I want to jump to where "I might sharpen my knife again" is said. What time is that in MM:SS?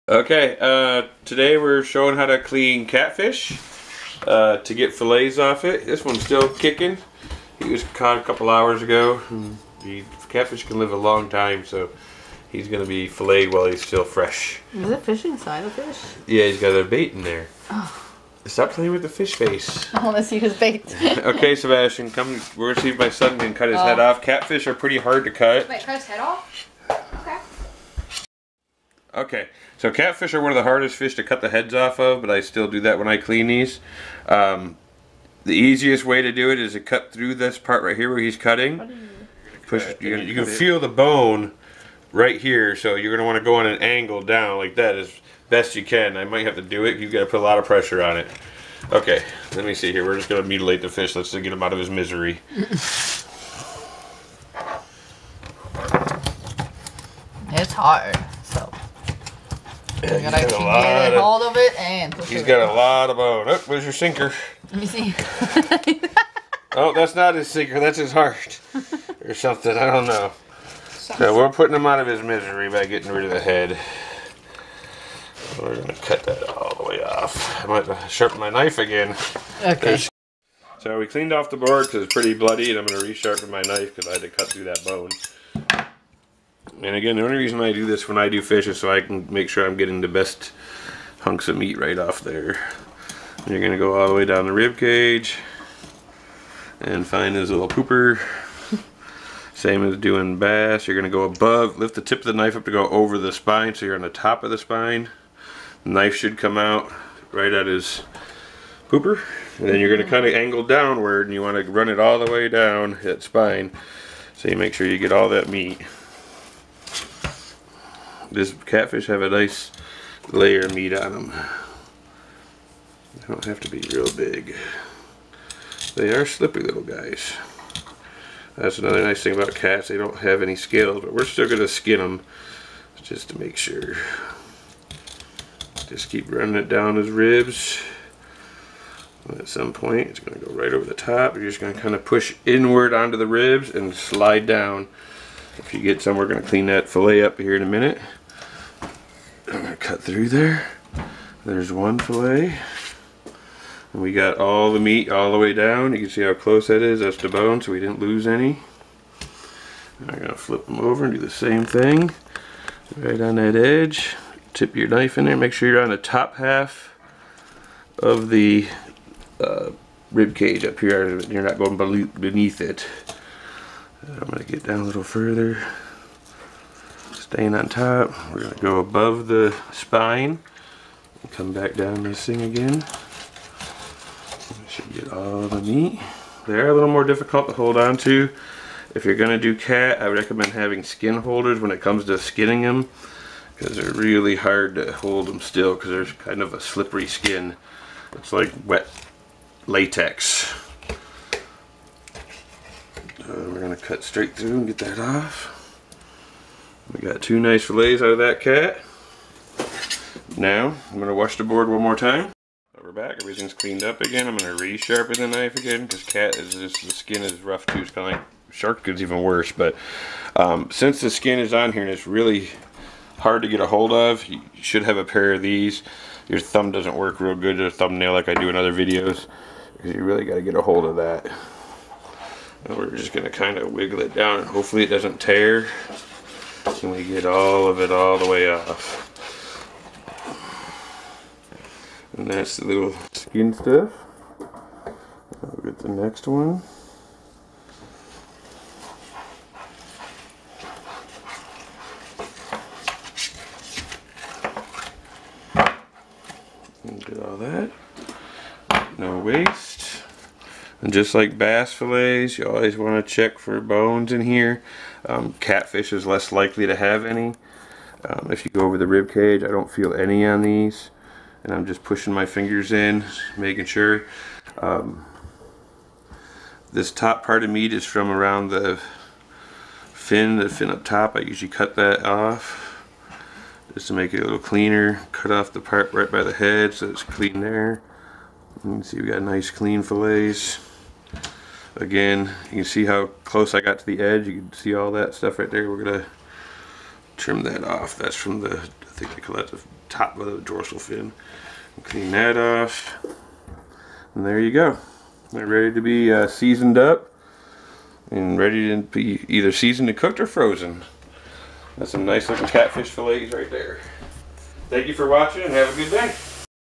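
01:17.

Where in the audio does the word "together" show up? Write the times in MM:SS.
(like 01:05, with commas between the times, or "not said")
not said.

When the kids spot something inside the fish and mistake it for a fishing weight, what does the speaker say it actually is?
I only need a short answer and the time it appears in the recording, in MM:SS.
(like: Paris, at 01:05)
His heart, at 01:07.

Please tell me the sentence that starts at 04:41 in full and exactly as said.
I usually cut that off just to make it a little cleaner.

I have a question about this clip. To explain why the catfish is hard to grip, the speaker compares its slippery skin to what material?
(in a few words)
Wet latex.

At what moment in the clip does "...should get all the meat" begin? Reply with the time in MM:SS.
03:04.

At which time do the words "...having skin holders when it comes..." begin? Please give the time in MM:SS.
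03:10.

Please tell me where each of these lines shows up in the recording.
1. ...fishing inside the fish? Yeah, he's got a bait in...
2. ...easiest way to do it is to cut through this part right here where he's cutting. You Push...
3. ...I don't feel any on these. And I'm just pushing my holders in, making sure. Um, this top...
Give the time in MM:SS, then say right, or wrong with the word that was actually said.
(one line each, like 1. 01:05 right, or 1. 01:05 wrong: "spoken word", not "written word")
1. 00:15 right
2. 00:35 right
3. 04:29 wrong: "fingers", not "holders".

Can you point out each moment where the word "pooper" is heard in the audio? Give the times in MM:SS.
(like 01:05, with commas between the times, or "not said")
01:37, 01:48.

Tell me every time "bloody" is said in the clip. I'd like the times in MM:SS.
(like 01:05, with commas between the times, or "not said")
01:22.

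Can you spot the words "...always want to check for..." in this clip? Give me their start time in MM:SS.
04:22.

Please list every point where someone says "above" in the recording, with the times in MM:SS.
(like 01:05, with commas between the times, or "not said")
01:41, 02:58.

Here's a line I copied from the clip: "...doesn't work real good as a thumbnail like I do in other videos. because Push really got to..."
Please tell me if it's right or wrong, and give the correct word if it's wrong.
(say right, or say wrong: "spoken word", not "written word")
wrong: "You", not "Push".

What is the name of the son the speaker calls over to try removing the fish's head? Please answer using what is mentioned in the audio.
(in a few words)
Sebastian.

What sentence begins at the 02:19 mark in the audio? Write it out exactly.
At some point, it's going to go right over the top.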